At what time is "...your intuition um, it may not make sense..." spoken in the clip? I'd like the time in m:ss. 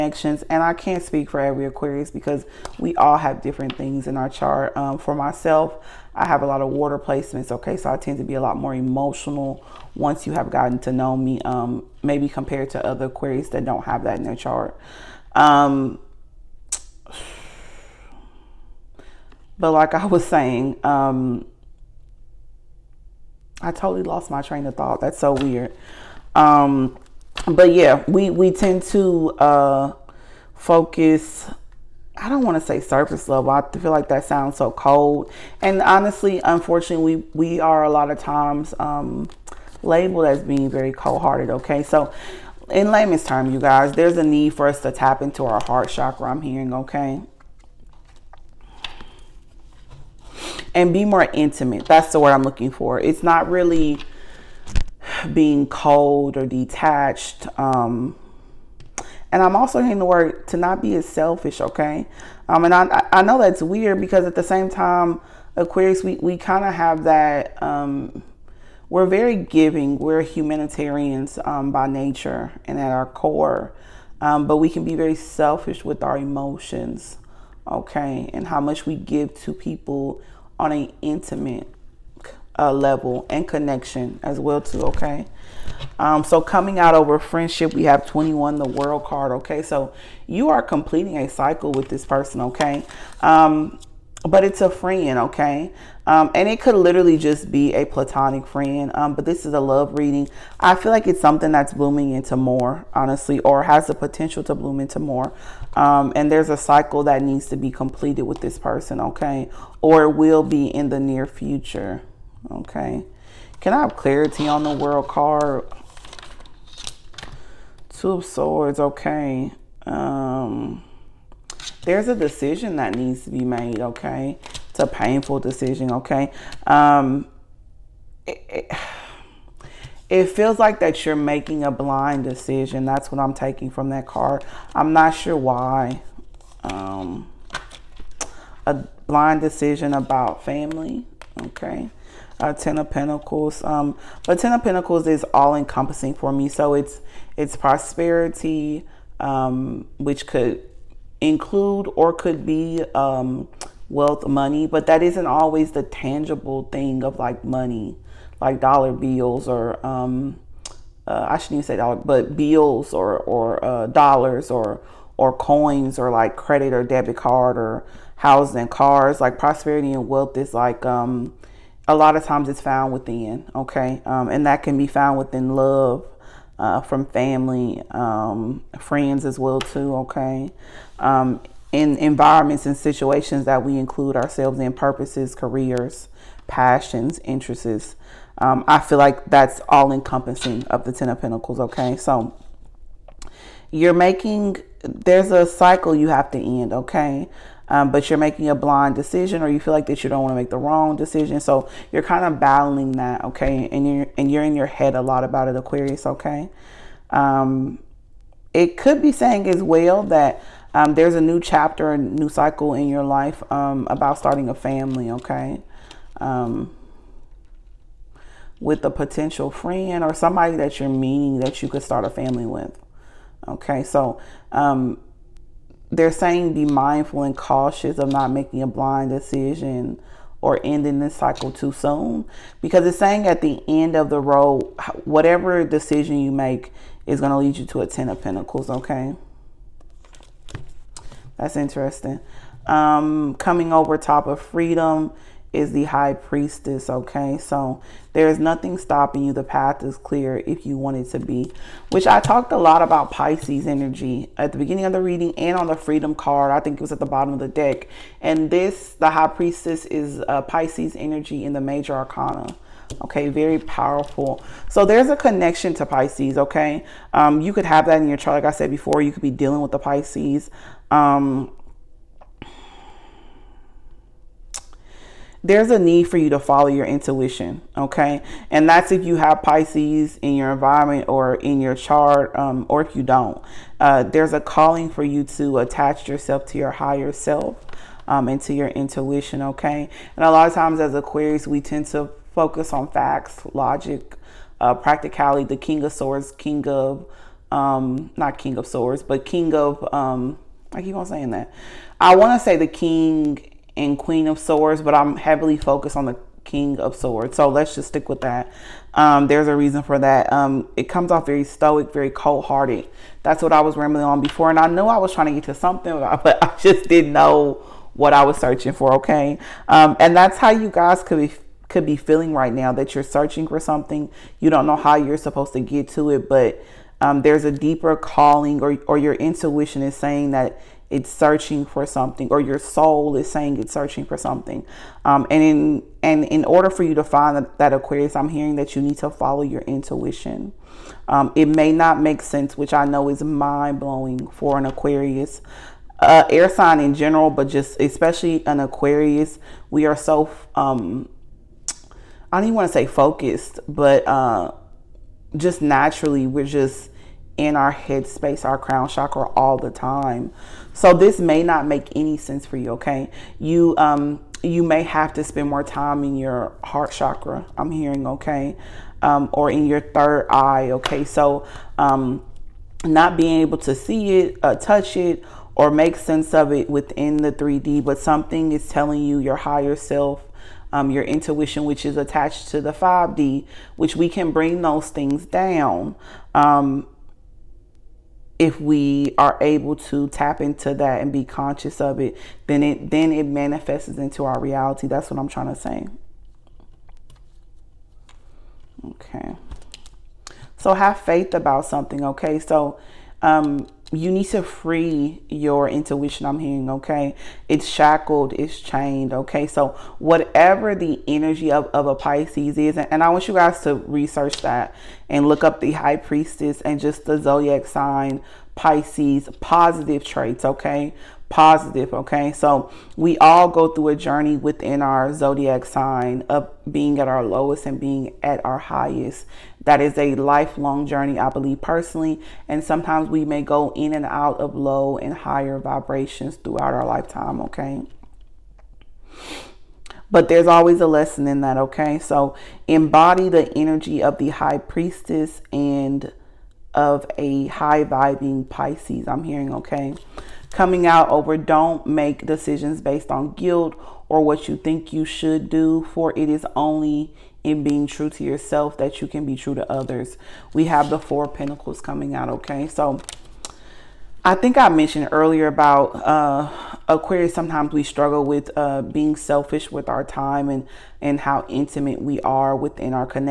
5:39.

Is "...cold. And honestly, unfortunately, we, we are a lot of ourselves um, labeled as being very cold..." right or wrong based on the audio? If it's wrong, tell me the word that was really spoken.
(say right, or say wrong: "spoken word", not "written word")
wrong: "times", not "ourselves".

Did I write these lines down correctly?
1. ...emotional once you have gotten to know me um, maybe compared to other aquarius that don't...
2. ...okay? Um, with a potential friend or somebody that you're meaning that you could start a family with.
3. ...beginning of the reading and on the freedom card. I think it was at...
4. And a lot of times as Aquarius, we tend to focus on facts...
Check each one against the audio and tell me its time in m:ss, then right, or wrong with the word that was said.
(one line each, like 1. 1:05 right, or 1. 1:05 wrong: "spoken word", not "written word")
1. 0:08 right
2. 3:35 right
3. 4:14 right
4. 4:50 right.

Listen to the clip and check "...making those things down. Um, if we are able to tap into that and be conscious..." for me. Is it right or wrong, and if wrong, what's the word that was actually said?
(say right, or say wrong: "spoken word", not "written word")
wrong: "bring", not "making".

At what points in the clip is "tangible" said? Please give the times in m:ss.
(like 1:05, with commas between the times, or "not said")
2:35.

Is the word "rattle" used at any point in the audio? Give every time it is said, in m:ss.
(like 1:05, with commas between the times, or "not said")
not said.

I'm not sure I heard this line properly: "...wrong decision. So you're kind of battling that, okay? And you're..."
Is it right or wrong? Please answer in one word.
right.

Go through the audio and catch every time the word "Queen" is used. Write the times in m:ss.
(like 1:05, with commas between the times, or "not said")
5:03.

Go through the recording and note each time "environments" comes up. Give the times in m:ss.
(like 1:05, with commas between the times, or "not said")
3:01, 4:40.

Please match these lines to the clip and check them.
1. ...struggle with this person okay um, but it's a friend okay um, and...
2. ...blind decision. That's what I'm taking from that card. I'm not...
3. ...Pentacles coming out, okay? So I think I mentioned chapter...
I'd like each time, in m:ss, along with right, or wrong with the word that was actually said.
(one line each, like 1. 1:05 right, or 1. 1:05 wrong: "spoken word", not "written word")
1. 1:31 wrong: "cycle", not "struggle"
2. 2:11 right
3. 7:41 wrong: "earlier", not "chapter".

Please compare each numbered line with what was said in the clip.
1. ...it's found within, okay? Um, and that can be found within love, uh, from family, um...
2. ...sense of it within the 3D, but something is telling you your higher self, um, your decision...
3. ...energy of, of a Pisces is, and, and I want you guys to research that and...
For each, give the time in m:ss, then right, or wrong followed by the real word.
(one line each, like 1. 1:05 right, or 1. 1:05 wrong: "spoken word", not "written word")
1. 2:52 right
2. 6:15 wrong: "intuition", not "decision"
3. 6:51 right.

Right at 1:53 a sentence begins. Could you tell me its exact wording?
Can I have clarity on the world card?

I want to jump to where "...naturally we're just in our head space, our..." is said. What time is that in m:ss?
5:55.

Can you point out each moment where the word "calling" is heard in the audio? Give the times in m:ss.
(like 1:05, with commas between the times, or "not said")
4:44, 5:27.